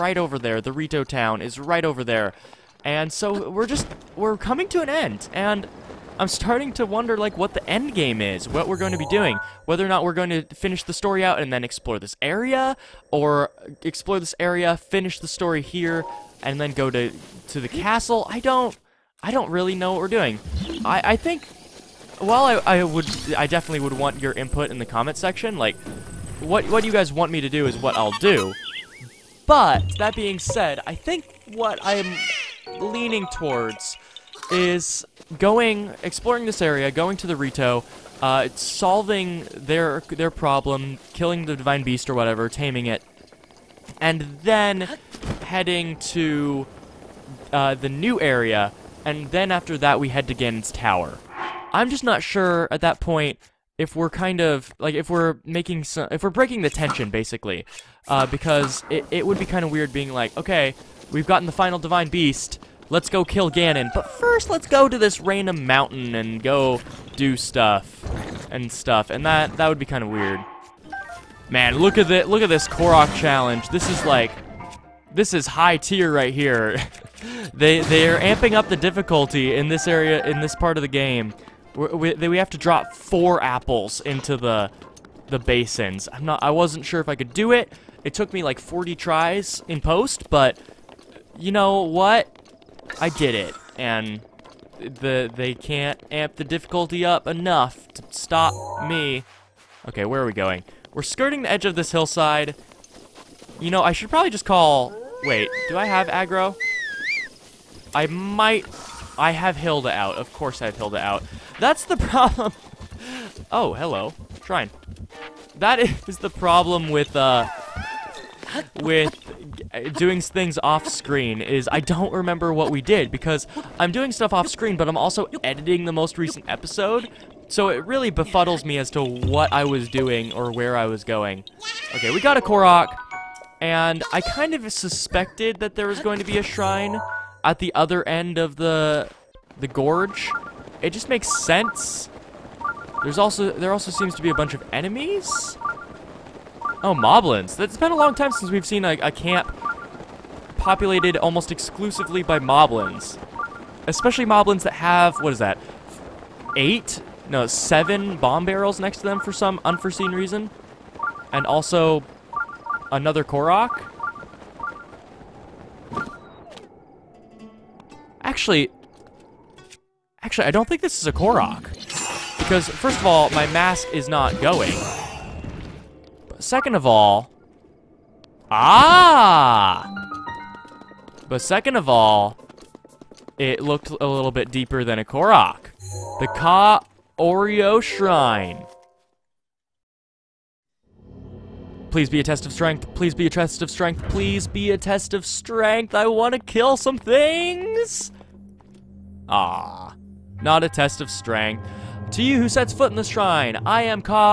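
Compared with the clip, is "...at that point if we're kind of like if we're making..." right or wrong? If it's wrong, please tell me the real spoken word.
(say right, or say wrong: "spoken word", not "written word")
right.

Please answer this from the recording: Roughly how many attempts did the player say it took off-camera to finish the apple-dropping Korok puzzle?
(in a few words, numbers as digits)
40.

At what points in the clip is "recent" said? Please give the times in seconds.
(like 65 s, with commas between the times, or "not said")
126 s.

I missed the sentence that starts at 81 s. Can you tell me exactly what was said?
We, we, we have to drop four apples into the the basins.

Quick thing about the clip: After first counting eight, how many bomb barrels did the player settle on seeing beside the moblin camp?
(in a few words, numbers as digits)
7.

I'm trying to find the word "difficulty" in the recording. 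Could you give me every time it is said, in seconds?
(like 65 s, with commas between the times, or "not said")
78 s, 96 s.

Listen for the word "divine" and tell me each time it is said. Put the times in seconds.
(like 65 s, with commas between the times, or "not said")
41 s, 61 s.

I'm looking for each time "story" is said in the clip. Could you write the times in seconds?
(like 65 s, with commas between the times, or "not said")
10 s, 15 s.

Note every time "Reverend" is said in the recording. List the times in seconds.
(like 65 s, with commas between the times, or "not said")
not said.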